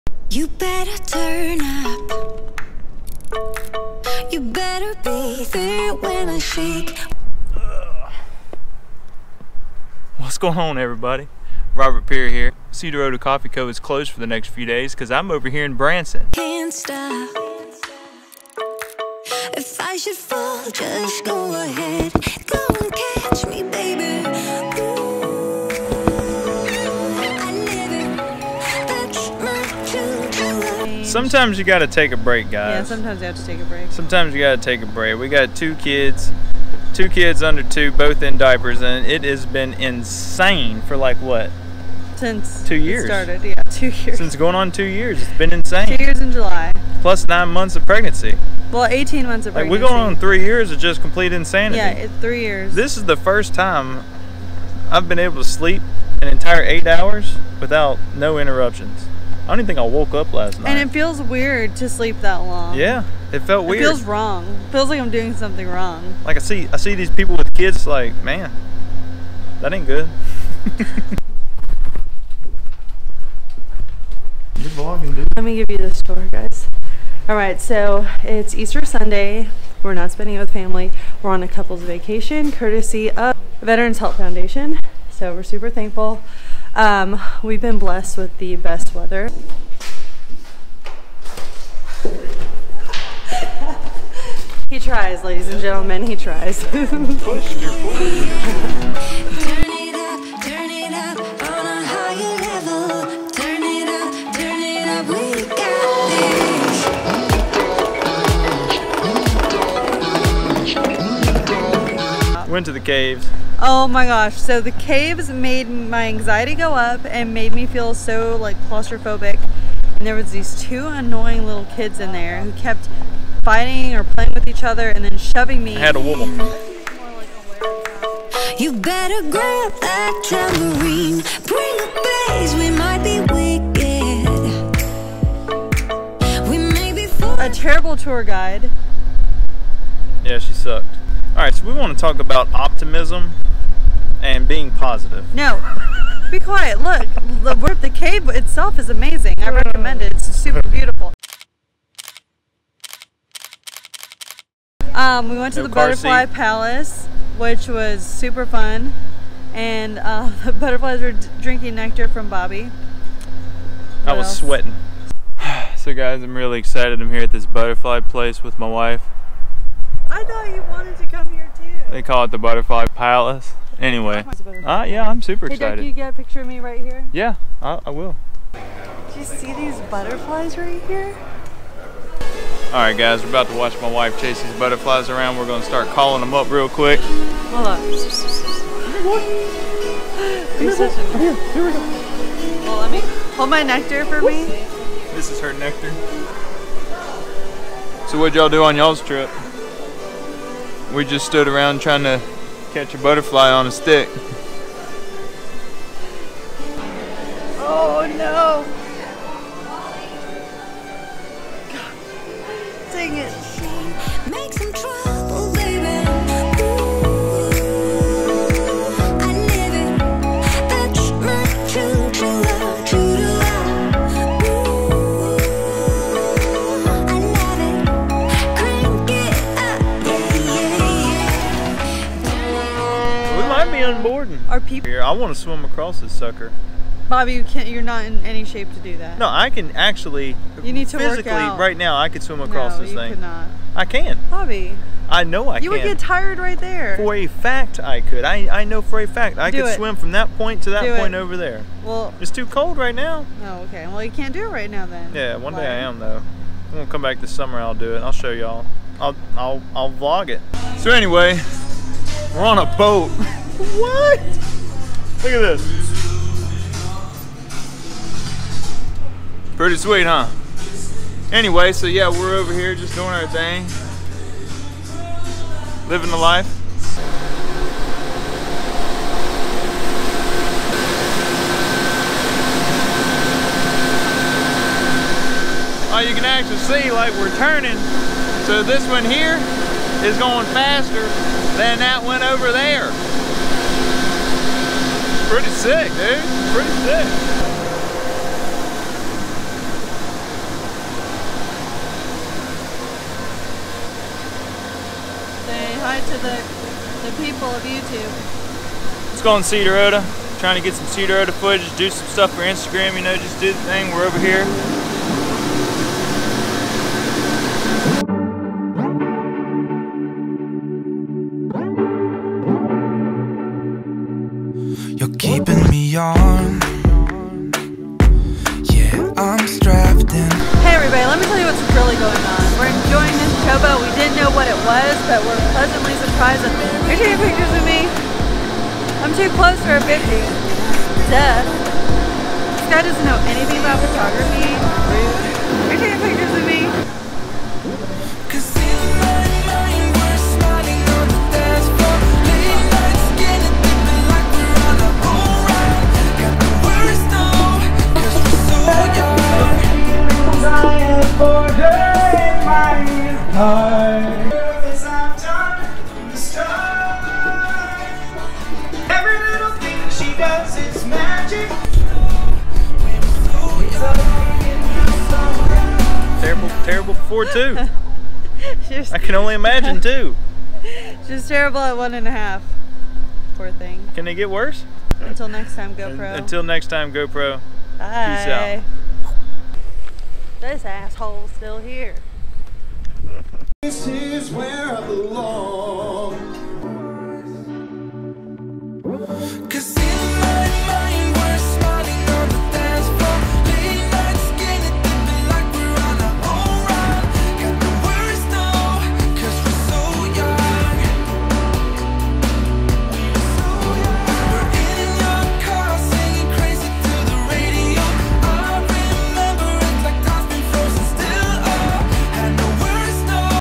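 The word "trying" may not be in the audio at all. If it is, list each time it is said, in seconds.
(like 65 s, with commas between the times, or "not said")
201 s, 310 s.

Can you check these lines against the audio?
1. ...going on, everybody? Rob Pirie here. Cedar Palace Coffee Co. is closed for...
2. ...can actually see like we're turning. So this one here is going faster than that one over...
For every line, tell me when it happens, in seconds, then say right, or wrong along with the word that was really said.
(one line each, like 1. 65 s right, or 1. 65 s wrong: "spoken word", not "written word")
1. 10 s wrong: "Ota", not "Palace"
2. 286 s right.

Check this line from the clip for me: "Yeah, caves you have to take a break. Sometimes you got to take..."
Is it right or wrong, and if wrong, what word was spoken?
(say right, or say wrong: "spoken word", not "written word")
wrong: "sometimes", not "caves".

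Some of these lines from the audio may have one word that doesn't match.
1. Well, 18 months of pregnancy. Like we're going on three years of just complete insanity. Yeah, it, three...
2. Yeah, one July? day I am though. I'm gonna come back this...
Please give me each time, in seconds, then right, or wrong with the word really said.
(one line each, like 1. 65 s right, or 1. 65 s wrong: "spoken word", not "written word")
1. 48 s right
2. 255 s wrong: "Why", not "July".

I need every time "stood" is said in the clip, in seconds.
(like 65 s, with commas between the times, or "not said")
201 s.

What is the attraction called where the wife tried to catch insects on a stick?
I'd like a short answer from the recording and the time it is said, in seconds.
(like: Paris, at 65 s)
Butterfly Palace, at 172 s.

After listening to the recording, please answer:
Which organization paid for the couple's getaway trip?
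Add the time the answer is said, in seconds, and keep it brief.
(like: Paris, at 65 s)
Veterans Help Foundation, at 83 s.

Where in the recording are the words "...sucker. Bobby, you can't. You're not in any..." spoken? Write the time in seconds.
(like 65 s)
236 s.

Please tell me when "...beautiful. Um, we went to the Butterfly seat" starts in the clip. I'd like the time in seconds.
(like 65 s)
150 s.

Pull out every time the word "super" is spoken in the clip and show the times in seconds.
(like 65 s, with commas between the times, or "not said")
85 s, 150 s, 158 s, 175 s.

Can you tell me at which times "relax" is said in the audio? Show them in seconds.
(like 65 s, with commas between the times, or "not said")
not said.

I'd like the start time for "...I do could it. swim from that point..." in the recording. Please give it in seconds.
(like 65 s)
249 s.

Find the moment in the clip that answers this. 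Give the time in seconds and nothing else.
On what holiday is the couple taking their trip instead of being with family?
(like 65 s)
78 s.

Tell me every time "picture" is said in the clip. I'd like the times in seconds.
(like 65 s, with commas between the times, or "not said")
176 s, 337 s.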